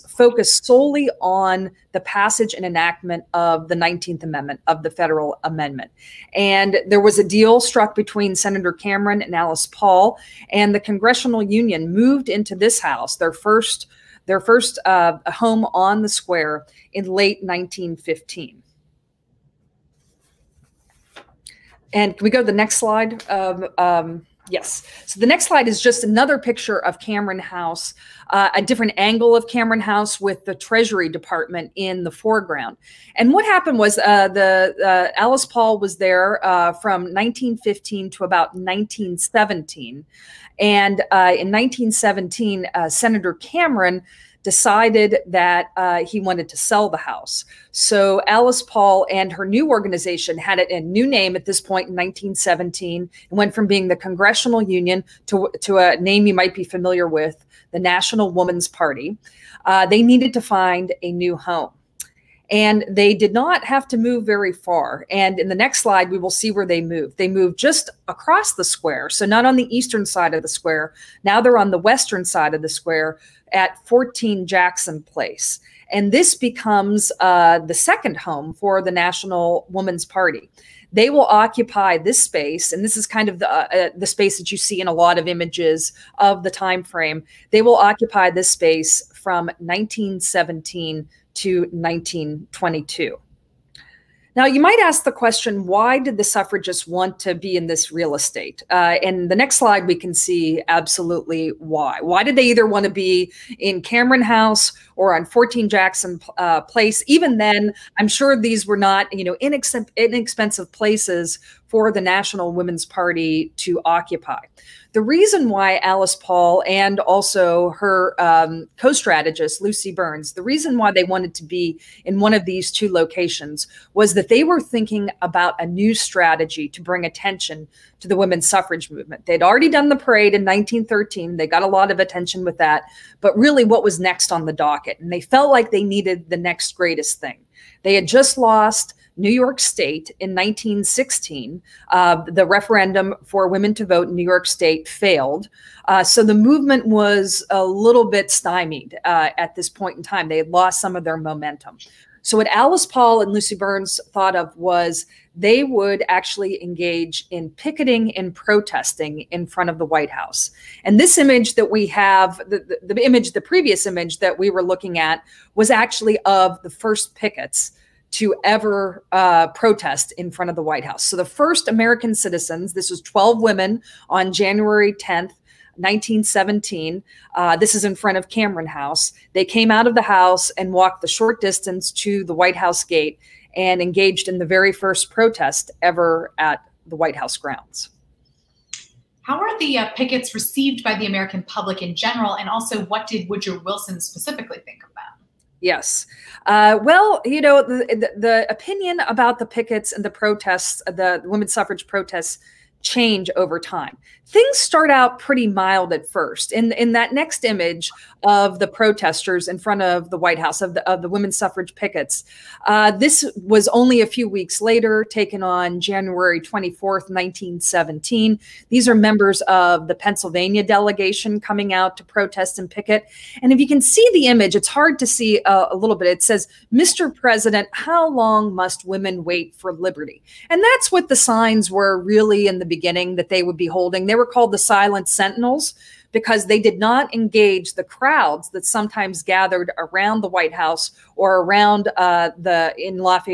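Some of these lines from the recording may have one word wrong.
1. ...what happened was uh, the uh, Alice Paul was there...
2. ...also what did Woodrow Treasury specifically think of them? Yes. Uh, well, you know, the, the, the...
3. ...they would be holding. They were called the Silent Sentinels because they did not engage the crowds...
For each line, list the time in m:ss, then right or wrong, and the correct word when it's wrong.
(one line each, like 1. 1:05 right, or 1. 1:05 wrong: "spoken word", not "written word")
1. 0:33 right
2. 3:12 wrong: "Wilson", not "Treasury"
3. 3:53 right.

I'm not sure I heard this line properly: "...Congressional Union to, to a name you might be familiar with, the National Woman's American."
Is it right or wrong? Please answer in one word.
wrong.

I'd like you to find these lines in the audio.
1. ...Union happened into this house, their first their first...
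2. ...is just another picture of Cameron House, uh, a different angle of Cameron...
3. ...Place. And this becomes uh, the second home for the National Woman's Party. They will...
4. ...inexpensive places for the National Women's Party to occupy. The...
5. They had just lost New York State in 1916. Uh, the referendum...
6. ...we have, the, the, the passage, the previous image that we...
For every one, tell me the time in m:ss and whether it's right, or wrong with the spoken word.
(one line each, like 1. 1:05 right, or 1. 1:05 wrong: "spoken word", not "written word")
1. 0:11 wrong: "moved", not "happened"
2. 0:25 right
3. 1:15 right
4. 1:49 right
5. 2:17 right
6. 2:41 wrong: "image", not "passage".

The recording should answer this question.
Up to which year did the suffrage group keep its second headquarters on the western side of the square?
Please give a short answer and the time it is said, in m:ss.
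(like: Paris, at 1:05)
1922, at 1:31.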